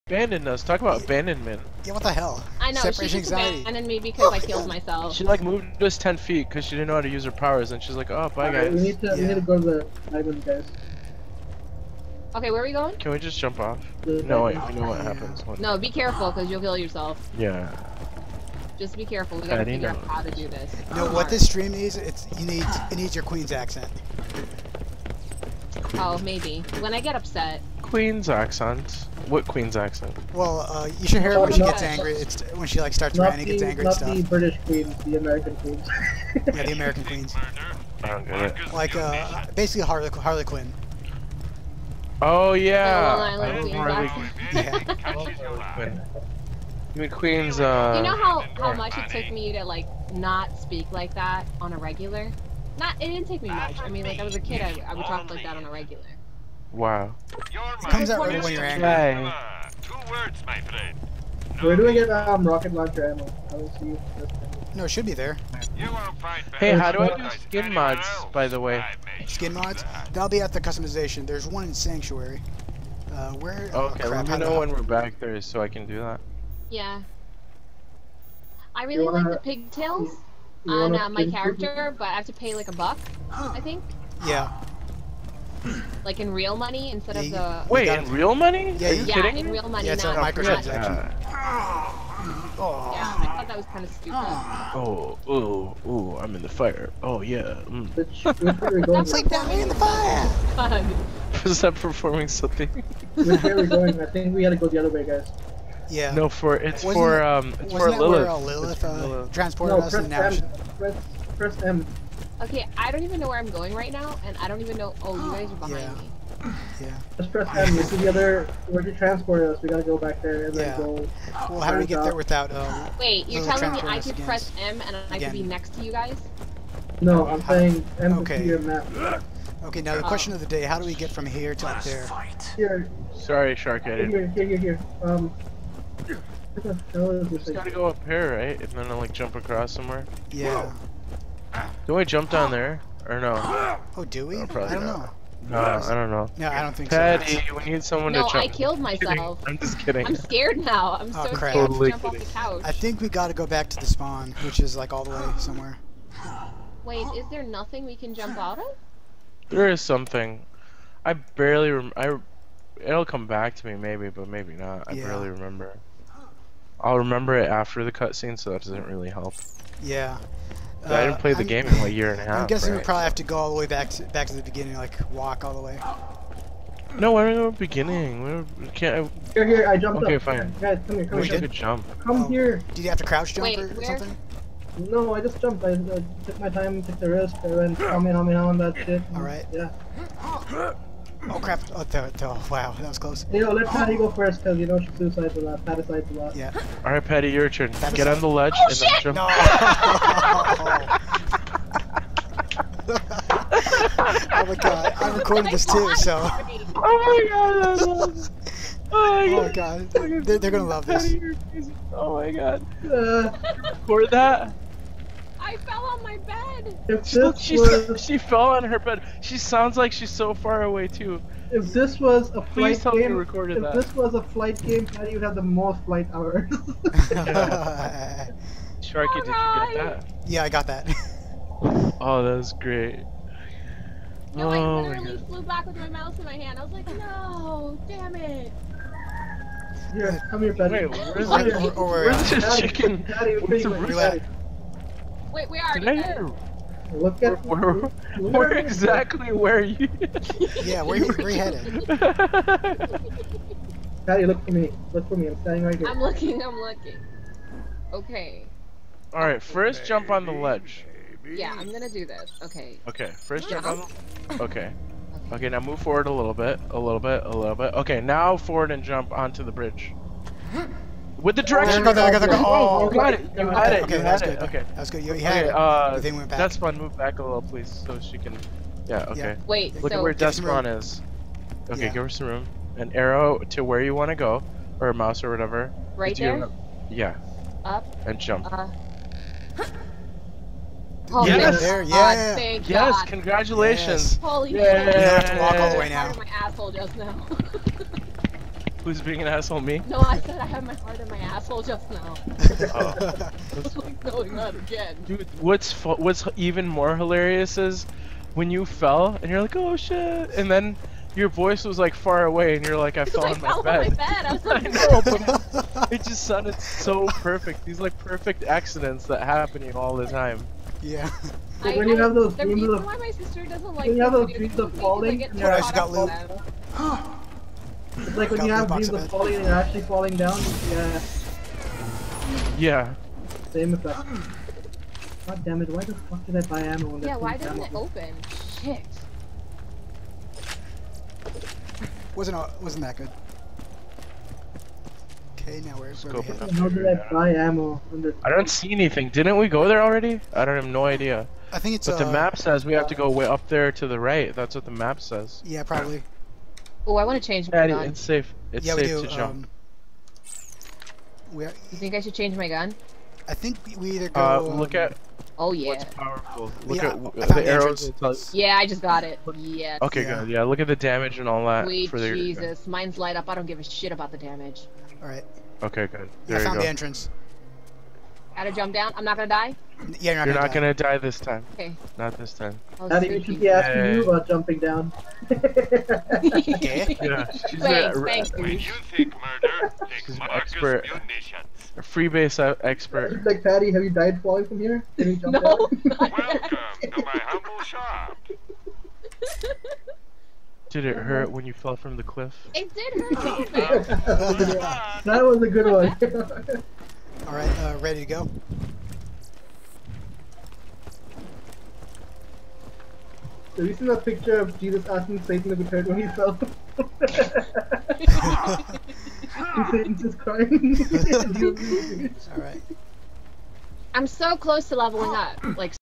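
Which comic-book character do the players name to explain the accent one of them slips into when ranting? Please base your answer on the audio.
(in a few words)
Harley Quinn.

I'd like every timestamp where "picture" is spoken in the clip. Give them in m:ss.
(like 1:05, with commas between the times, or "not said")
6:54.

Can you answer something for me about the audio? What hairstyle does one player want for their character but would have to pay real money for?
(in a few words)
pigtails.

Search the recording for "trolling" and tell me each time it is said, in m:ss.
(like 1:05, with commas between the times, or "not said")
not said.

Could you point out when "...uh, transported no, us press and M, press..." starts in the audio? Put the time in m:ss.
1:49.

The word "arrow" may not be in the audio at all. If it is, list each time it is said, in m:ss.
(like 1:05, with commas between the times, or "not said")
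4:42, 6:07.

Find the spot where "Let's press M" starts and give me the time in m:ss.
1:57.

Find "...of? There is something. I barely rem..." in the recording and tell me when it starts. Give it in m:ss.
2:38.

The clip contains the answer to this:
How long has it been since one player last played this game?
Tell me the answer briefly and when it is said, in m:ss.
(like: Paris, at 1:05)
a year and a half, at 2:51.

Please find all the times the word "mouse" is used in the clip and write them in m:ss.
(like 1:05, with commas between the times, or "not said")
3:55, 4:44.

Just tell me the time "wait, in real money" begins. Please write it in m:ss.
1:27.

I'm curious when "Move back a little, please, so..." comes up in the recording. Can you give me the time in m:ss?
4:36.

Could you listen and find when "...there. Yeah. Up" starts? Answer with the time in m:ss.
4:46.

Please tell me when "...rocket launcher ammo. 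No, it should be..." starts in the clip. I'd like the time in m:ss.
1:02.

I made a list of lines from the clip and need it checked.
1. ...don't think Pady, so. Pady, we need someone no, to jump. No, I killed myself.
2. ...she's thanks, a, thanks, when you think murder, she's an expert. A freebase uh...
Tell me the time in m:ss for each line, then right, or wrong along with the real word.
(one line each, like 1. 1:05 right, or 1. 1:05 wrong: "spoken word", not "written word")
1. 2:26 right
2. 6:26 right.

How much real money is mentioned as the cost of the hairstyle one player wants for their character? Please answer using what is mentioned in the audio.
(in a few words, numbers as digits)
a buck.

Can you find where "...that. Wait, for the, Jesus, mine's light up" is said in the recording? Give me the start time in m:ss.
6:11.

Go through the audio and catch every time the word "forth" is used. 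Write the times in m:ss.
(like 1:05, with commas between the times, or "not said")
not said.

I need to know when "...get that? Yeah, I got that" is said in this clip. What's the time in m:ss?
3:49.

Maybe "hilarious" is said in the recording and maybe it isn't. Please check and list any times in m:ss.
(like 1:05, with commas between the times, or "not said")
5:06.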